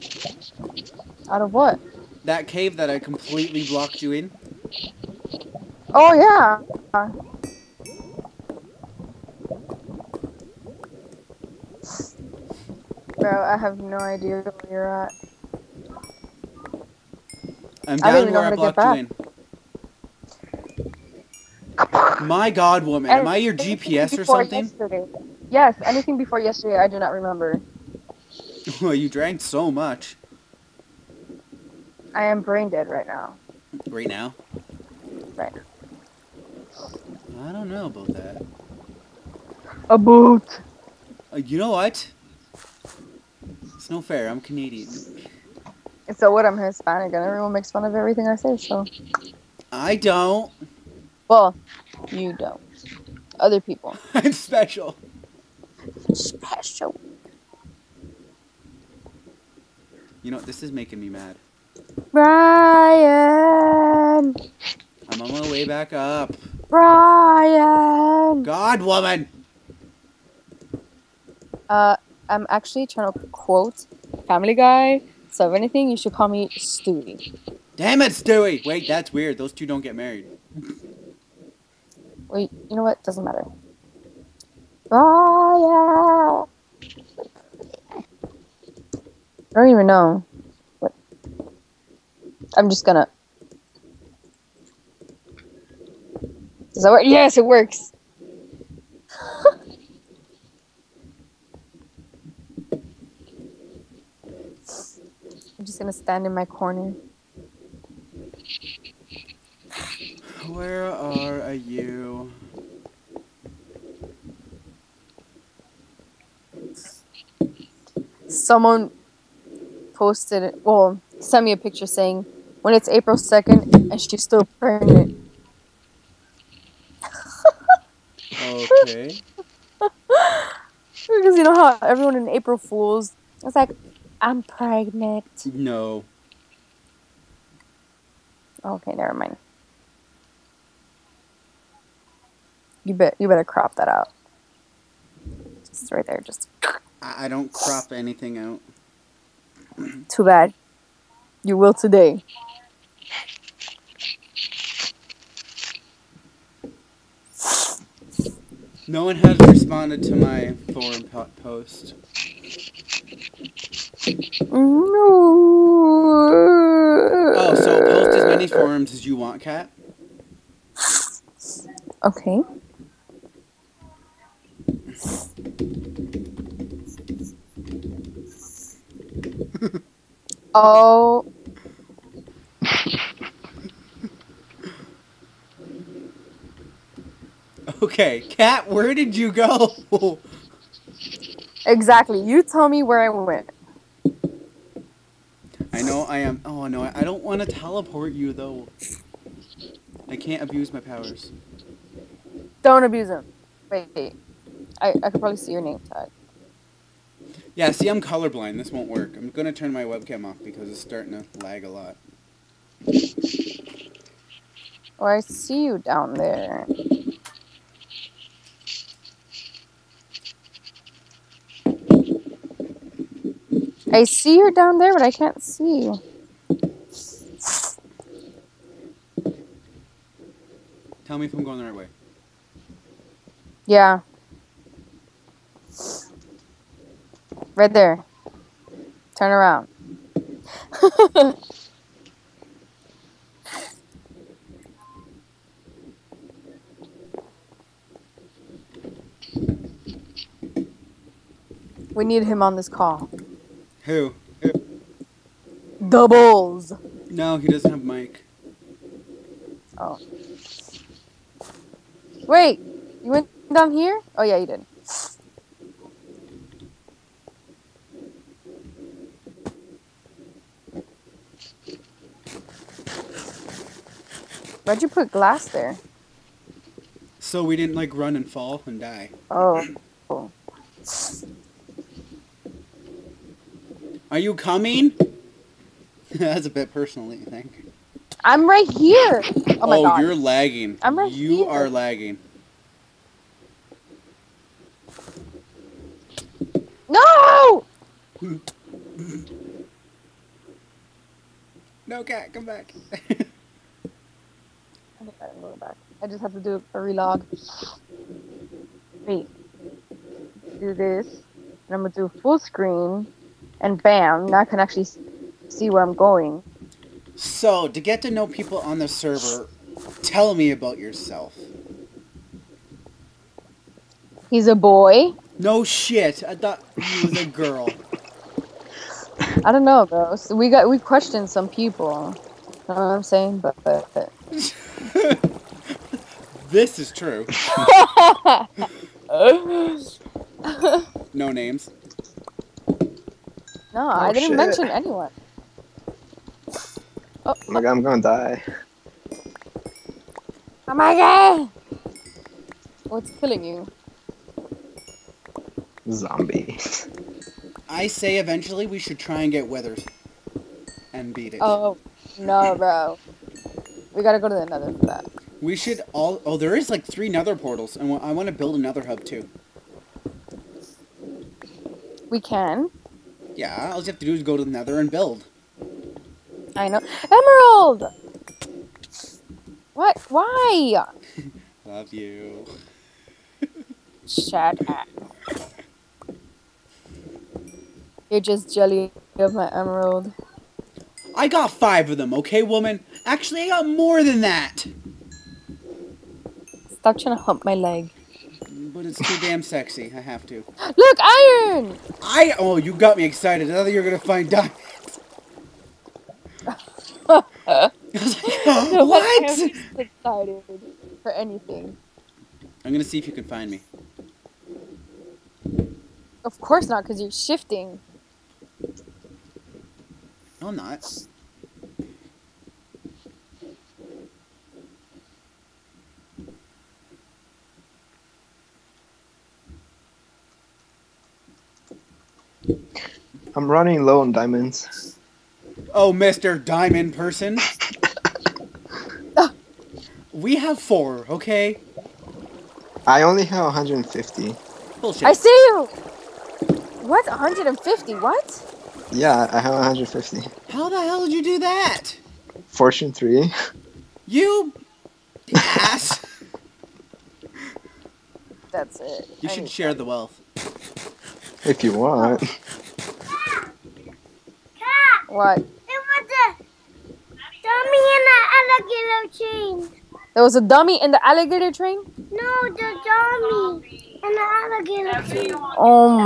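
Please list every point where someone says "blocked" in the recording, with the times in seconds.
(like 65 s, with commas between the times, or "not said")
3 s, 18 s.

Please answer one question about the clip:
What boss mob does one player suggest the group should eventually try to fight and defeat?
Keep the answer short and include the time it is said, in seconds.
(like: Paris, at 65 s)
Withers, at 359 s.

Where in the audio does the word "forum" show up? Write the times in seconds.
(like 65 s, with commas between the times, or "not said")
160 s, 168 s.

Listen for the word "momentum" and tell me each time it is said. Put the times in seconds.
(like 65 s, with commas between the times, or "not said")
not said.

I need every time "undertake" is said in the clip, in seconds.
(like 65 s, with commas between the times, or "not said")
not said.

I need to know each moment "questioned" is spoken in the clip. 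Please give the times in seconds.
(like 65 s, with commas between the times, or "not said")
330 s.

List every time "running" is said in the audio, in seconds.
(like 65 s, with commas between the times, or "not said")
433 s.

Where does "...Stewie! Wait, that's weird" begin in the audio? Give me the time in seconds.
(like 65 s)
78 s.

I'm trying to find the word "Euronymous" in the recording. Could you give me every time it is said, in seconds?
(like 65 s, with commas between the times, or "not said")
not said.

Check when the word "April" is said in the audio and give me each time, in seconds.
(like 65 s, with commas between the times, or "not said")
122 s, 132 s.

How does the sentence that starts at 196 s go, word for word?
Oh no, I don't want to teleport you though.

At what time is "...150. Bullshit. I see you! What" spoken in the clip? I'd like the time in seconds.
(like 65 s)
443 s.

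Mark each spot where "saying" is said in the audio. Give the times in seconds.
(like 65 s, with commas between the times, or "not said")
121 s, 333 s.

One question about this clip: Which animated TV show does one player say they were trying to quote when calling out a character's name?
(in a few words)
Family Guy.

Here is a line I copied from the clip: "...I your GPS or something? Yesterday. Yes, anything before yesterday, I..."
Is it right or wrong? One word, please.
right.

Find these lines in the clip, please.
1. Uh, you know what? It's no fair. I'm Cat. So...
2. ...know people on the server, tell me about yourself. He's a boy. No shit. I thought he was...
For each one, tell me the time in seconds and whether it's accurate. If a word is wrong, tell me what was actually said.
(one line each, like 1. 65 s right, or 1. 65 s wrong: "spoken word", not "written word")
1. 41 s wrong: "Canadian", not "Cat"
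2. 318 s right.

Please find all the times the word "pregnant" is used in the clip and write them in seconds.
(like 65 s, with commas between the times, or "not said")
124 s, 134 s.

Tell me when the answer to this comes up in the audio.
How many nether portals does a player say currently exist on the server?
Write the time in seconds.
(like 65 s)
366 s.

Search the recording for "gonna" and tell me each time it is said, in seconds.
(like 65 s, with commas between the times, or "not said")
92 s, 105 s, 347 s, 403 s, 412 s.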